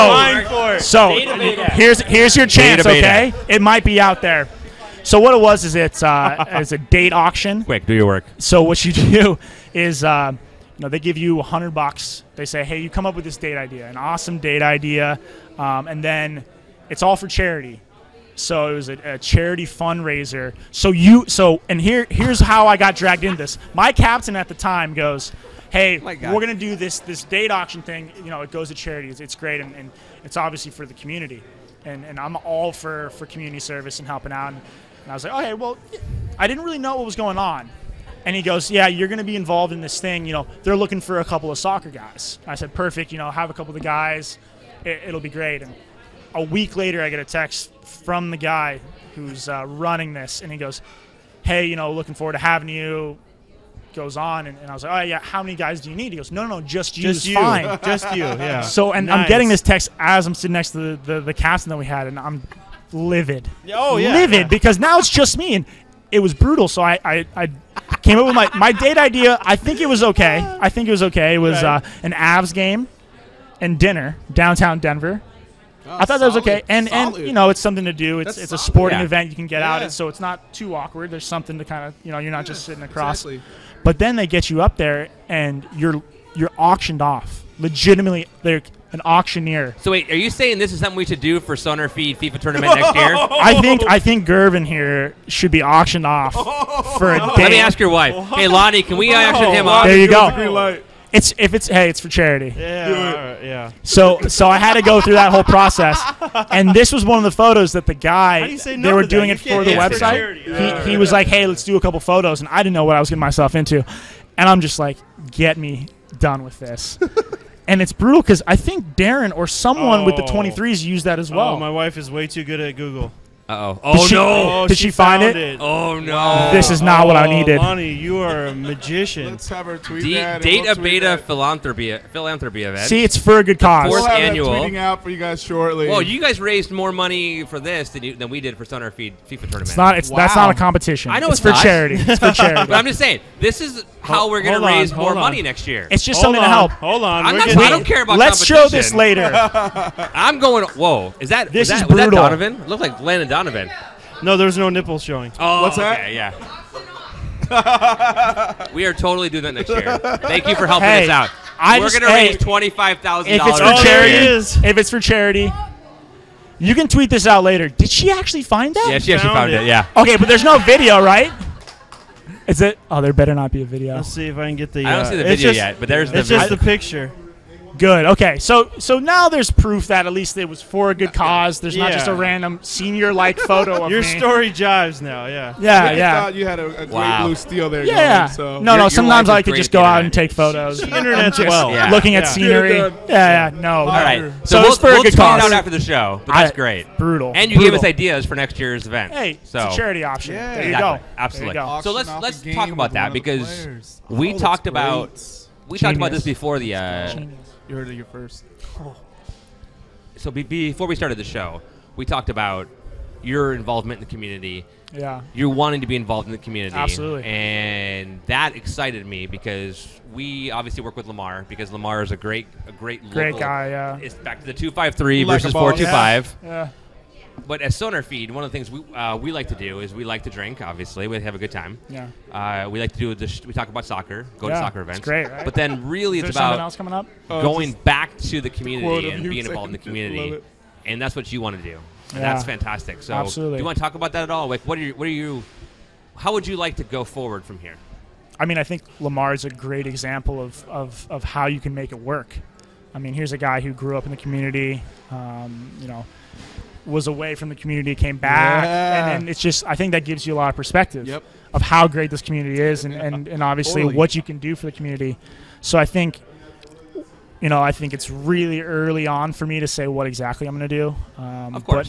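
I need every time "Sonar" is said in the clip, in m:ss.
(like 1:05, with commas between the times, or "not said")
1:31, 2:18, 3:47.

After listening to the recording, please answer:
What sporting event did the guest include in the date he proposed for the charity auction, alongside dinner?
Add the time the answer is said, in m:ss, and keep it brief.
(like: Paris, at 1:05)
An Avs game, at 1:12.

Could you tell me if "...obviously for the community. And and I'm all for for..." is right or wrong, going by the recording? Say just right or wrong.
right.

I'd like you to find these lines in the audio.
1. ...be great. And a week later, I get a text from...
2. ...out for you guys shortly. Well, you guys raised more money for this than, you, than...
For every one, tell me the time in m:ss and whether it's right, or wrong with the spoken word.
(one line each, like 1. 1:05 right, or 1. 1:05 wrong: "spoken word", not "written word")
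1. 0:45 right
2. 2:14 right.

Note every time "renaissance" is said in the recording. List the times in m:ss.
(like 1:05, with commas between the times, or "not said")
not said.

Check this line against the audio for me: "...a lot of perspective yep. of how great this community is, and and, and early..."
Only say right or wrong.
wrong.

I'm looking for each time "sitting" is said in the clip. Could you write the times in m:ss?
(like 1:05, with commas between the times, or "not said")
1:00, 1:22.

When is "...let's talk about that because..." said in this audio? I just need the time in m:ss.
3:22.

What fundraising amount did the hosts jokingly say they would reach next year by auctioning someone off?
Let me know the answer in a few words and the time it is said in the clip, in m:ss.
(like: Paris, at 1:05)
25,000, at 2:42.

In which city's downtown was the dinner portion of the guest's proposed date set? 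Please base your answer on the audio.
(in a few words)
Denver.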